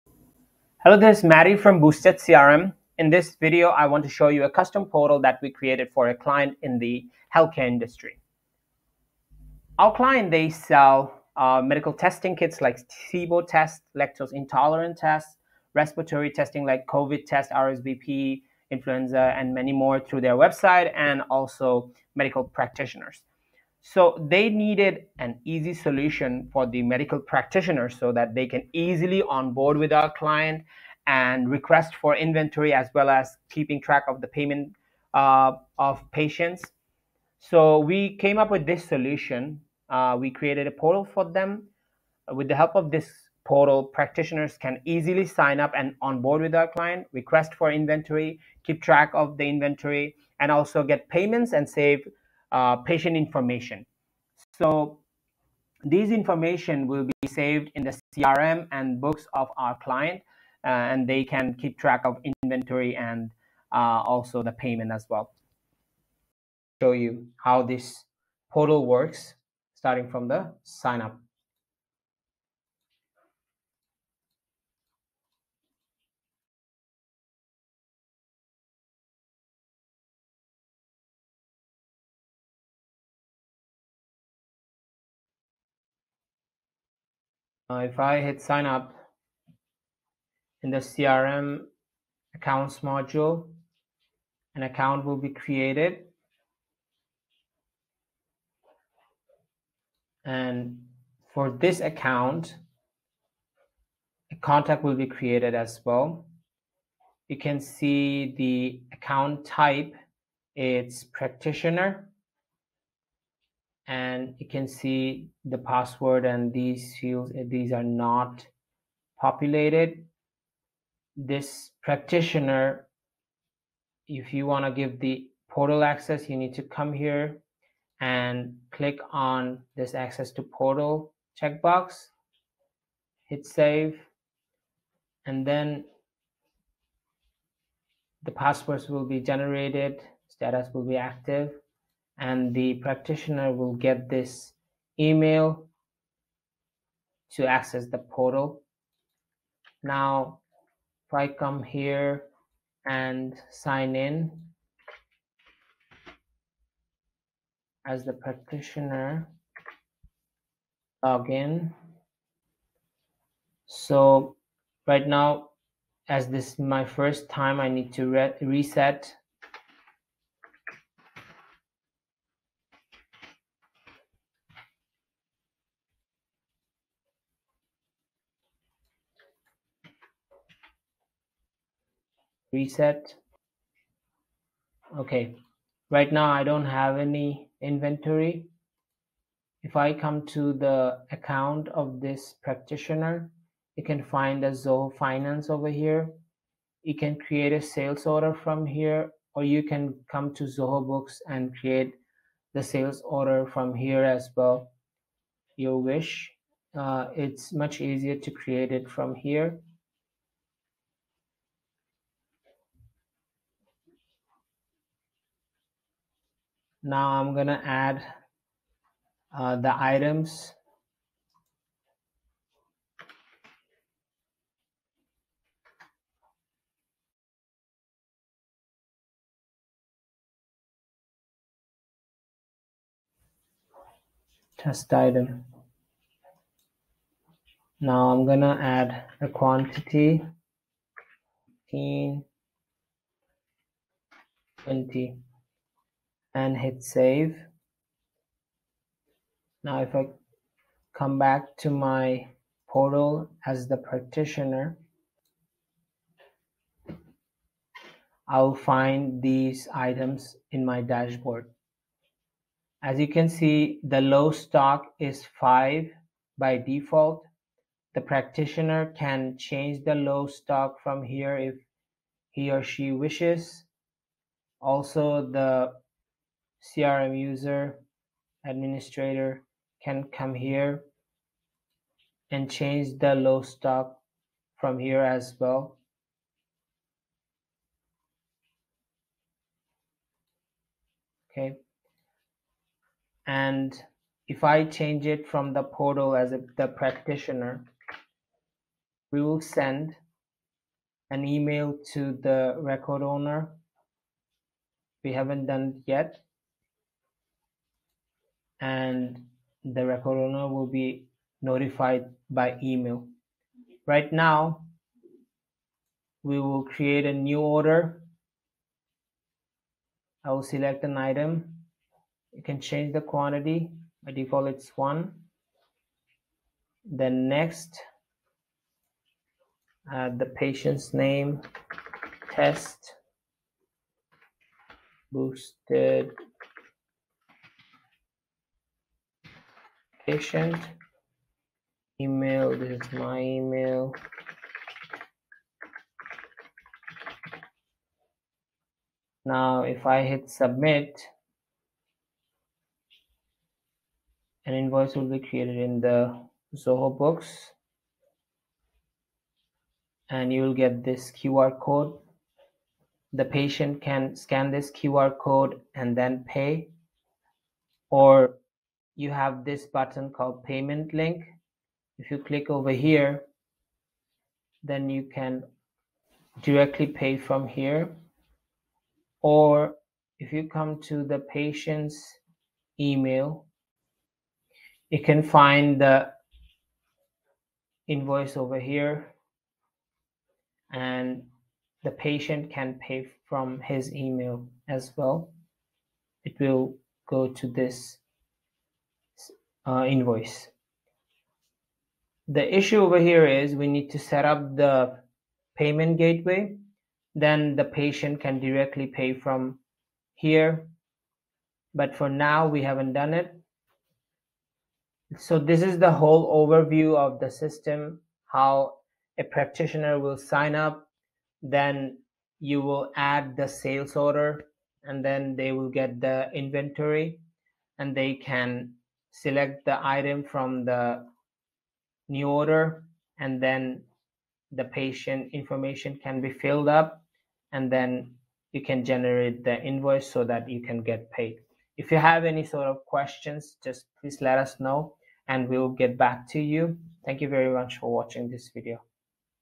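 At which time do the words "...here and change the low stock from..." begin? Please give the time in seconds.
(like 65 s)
280 s.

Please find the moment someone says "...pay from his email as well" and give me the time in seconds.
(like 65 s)
392 s.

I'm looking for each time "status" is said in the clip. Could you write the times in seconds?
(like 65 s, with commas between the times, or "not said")
140 s.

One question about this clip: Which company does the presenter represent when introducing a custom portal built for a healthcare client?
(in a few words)
Boosted CRM.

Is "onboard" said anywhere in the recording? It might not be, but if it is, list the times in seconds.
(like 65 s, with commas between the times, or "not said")
29 s, 46 s.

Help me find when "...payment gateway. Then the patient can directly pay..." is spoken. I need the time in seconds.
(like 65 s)
405 s.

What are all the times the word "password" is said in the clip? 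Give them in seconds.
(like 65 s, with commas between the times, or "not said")
115 s, 138 s.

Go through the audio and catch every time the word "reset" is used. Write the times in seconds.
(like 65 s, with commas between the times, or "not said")
168 s, 182 s.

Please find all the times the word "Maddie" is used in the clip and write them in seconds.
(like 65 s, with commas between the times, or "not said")
1 s.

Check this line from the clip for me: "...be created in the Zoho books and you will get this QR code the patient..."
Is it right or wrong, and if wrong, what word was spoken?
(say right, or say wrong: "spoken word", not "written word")
right.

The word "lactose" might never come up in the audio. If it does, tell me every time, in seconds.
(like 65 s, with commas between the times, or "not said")
13 s.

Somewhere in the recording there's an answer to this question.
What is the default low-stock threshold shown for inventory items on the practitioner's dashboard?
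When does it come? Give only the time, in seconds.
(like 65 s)
265 s.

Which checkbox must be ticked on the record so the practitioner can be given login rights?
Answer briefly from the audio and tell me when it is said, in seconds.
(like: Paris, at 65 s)
access to portal, at 129 s.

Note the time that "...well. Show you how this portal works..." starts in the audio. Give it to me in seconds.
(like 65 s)
65 s.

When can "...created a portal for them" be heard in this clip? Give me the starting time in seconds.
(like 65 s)
40 s.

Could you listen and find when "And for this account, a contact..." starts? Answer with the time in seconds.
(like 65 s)
100 s.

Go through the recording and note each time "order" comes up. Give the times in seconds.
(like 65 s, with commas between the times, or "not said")
198 s, 203 s, 317 s, 423 s, 432 s.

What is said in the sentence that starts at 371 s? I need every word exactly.
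If you click over here, then you can directly pay from here.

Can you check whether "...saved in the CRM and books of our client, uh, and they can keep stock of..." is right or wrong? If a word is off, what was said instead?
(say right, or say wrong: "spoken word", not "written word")
wrong: "track", not "stock".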